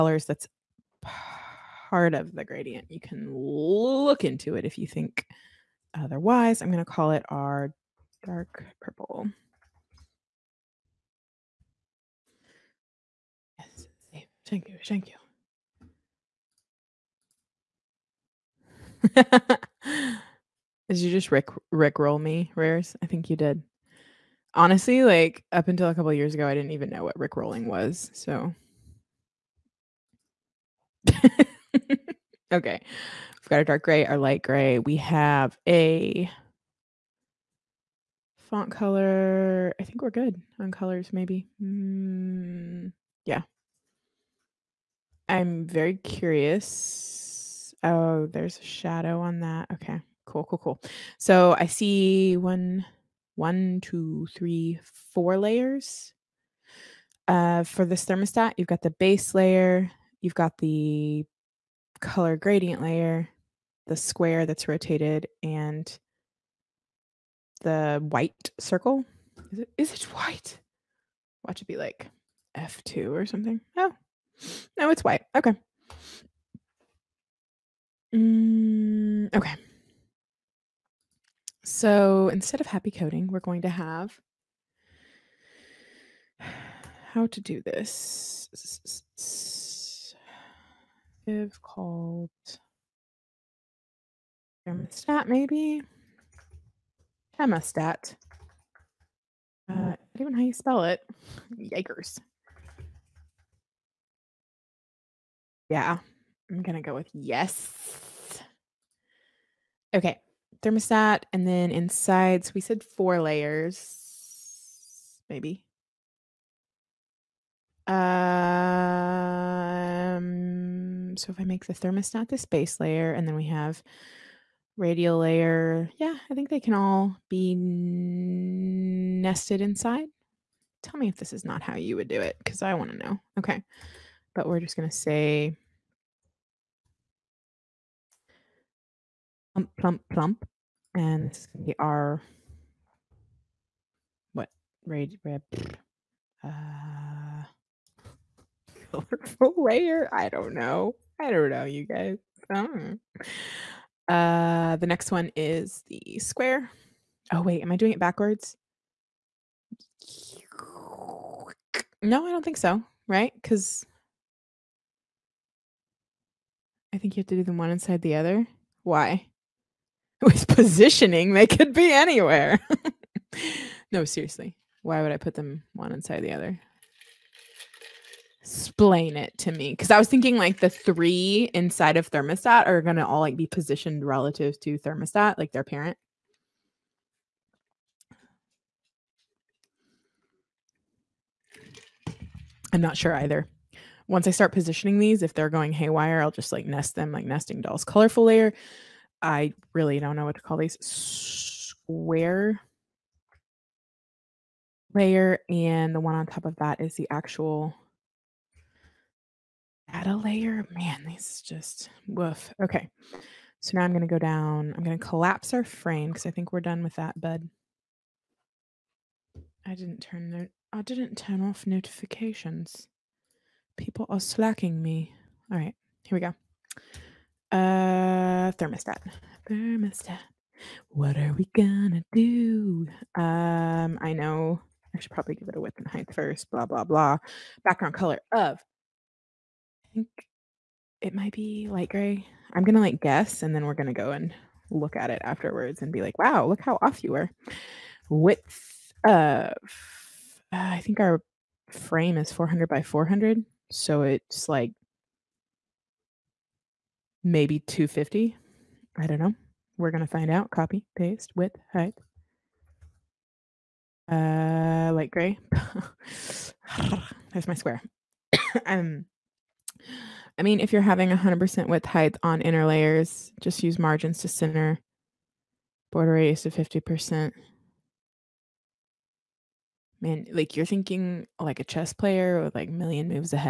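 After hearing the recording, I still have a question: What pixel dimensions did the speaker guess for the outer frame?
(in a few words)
400 by 400.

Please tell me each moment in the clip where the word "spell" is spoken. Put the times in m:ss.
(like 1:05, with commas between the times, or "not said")
1:40.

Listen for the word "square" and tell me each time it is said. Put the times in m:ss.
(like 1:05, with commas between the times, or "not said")
1:03, 2:36, 3:20, 4:27.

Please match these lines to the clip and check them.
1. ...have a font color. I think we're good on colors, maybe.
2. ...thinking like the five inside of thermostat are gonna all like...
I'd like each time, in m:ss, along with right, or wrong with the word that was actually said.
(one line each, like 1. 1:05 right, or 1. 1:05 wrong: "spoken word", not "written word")
1. 0:34 right
2. 3:00 wrong: "three", not "five".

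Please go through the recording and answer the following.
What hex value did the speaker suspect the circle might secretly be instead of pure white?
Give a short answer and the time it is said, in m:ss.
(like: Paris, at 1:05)
F2, at 1:12.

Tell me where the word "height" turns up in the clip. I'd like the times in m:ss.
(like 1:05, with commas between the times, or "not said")
3:55, 4:21, 4:31.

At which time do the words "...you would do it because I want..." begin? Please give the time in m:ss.
2:11.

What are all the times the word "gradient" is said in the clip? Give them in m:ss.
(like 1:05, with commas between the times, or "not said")
0:02, 1:02.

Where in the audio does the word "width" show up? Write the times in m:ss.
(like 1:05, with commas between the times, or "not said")
3:55, 4:08, 4:21, 4:31.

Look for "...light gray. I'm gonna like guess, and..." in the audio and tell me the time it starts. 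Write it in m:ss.
4:01.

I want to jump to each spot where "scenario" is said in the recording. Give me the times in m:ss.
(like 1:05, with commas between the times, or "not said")
not said.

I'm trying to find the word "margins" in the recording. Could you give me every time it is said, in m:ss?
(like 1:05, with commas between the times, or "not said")
4:33.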